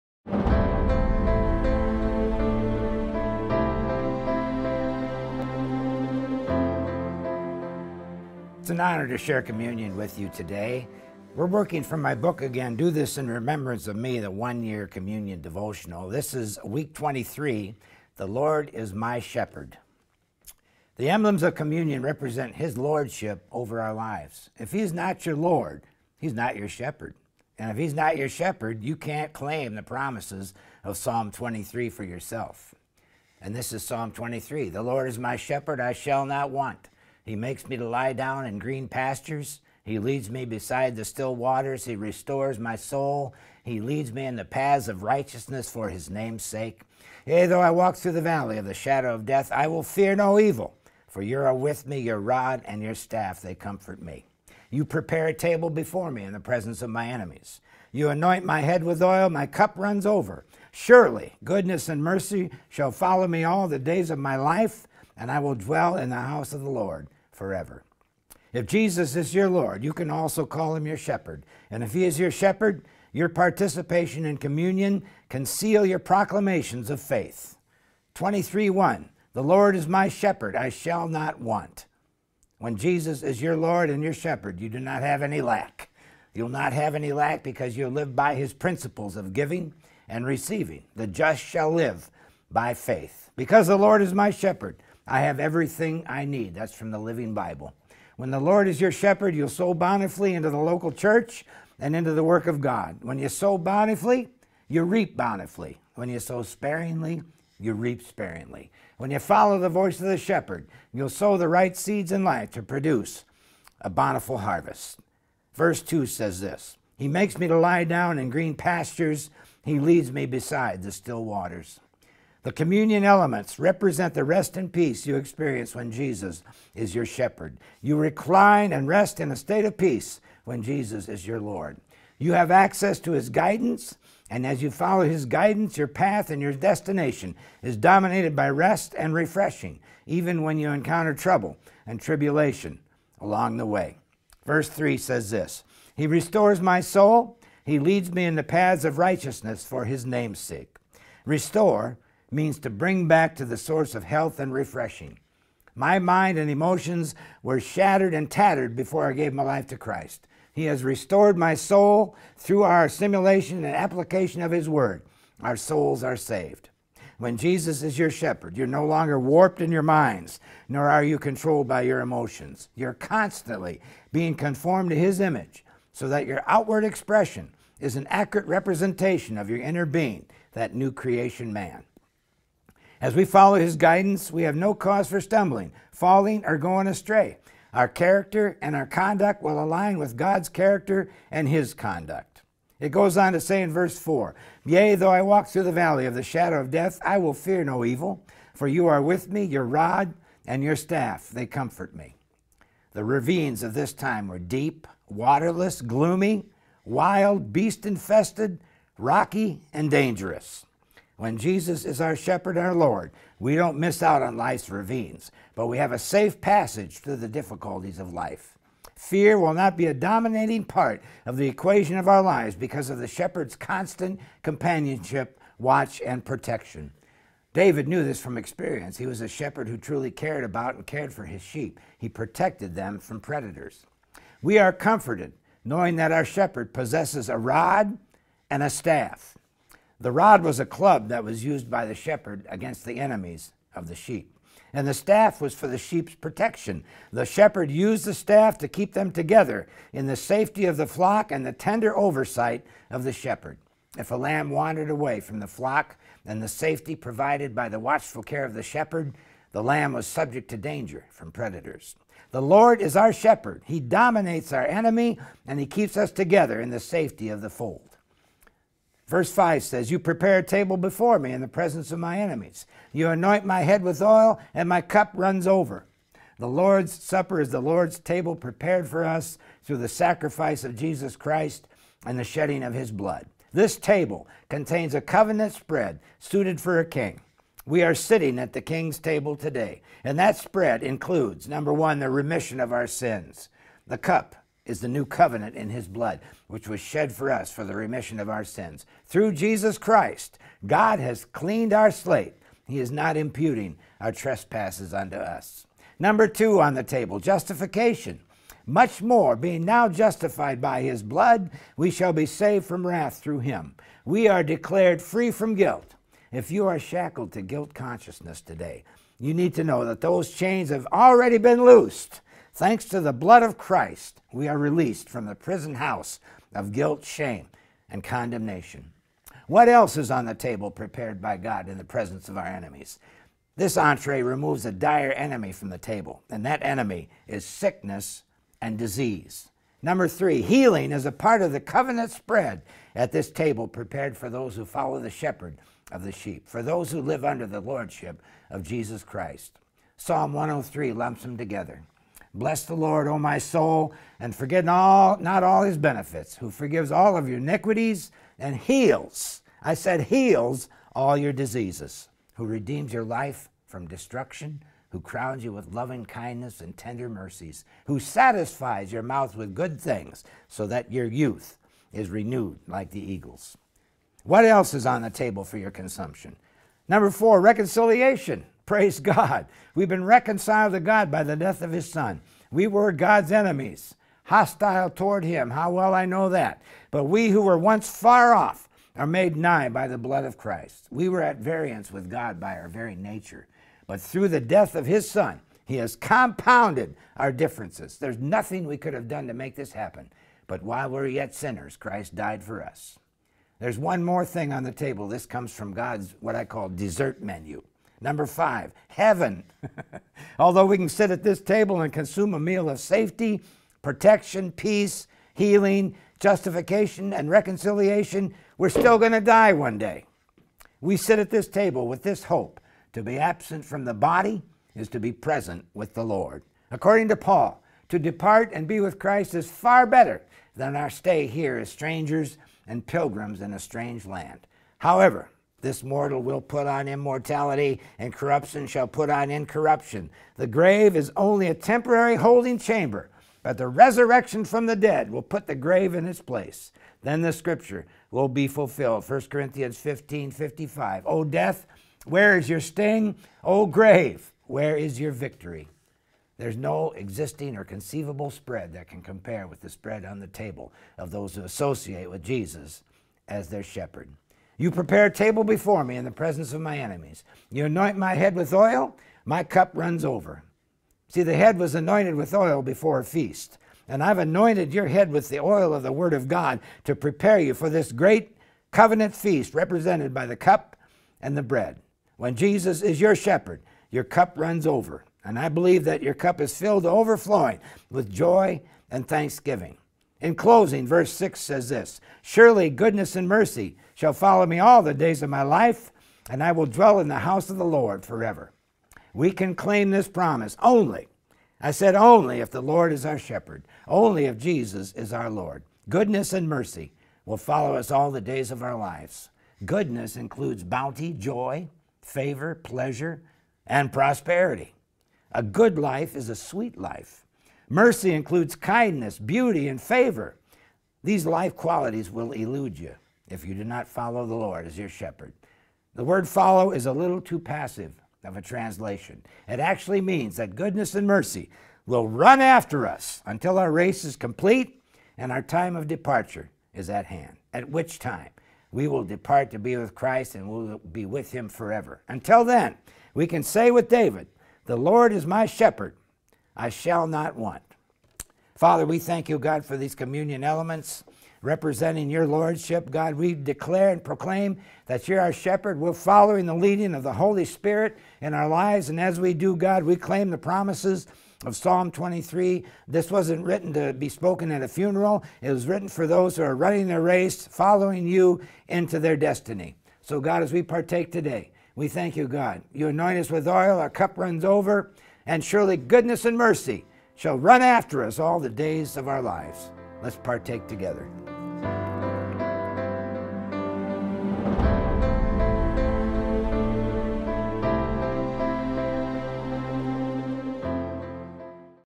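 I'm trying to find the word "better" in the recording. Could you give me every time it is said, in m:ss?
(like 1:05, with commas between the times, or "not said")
7:09.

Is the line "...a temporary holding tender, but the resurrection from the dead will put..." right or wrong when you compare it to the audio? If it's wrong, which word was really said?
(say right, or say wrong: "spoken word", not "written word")
wrong: "chamber", not "tender".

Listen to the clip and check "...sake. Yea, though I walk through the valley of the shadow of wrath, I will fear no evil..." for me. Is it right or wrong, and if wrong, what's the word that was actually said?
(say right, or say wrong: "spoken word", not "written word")
wrong: "death", not "wrath".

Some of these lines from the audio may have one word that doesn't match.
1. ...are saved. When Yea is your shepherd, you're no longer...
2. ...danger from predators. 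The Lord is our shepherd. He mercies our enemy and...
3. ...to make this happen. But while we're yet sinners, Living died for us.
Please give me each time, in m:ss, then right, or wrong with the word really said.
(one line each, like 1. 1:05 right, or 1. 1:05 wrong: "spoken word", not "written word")
1. 2:46 wrong: "Jesus", not "Yea"
2. 4:20 wrong: "dominates", not "mercies"
3. 6:39 wrong: "Christ", not "Living".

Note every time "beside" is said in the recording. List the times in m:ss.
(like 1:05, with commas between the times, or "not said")
0:40, 2:00.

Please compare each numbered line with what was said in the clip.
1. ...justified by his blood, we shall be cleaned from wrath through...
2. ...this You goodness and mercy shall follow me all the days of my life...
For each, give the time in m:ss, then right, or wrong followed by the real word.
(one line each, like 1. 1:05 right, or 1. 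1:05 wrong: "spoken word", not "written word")
1. 5:09 wrong: "saved", not "cleaned"
2. 8:11 wrong: "Surely", not "You".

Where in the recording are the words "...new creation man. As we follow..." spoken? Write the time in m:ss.
3:00.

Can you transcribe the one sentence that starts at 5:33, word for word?
This entree removes a dire enemy from the table, and that enemy is sickness and disease.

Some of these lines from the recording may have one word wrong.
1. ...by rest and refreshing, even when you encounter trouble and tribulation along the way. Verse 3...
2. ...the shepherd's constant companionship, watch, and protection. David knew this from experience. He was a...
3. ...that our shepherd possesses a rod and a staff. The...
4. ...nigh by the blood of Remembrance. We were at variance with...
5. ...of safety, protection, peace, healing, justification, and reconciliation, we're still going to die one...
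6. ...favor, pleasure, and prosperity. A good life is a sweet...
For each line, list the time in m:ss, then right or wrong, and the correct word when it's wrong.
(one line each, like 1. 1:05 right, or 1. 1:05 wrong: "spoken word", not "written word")
1. 2:18 right
2. 3:42 right
3. 3:55 right
4. 6:29 wrong: "Christ", not "Remembrance"
5. 6:52 right
6. 8:32 right.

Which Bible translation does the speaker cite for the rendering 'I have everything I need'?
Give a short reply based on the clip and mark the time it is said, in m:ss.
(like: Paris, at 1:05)
Living Bible, at 1:36.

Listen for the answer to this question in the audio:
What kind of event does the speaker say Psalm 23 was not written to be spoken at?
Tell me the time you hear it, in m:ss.
9:24.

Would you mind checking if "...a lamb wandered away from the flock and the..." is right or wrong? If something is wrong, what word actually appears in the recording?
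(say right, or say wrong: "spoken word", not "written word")
right.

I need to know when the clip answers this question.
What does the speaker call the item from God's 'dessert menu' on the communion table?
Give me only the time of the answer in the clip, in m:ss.
6:48.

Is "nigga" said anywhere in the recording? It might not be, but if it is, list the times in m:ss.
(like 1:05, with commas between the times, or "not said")
not said.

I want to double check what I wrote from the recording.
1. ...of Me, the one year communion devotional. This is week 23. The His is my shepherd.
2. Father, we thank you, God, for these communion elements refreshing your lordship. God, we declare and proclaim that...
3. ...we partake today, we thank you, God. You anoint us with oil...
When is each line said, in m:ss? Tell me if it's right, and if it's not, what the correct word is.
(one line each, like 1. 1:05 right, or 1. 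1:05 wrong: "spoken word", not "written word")
1. 0:13 wrong: "Lord", not "His"
2. 9:08 wrong: "representing", not "refreshing"
3. 9:30 right.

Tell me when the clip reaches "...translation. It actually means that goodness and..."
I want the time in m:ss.
8:48.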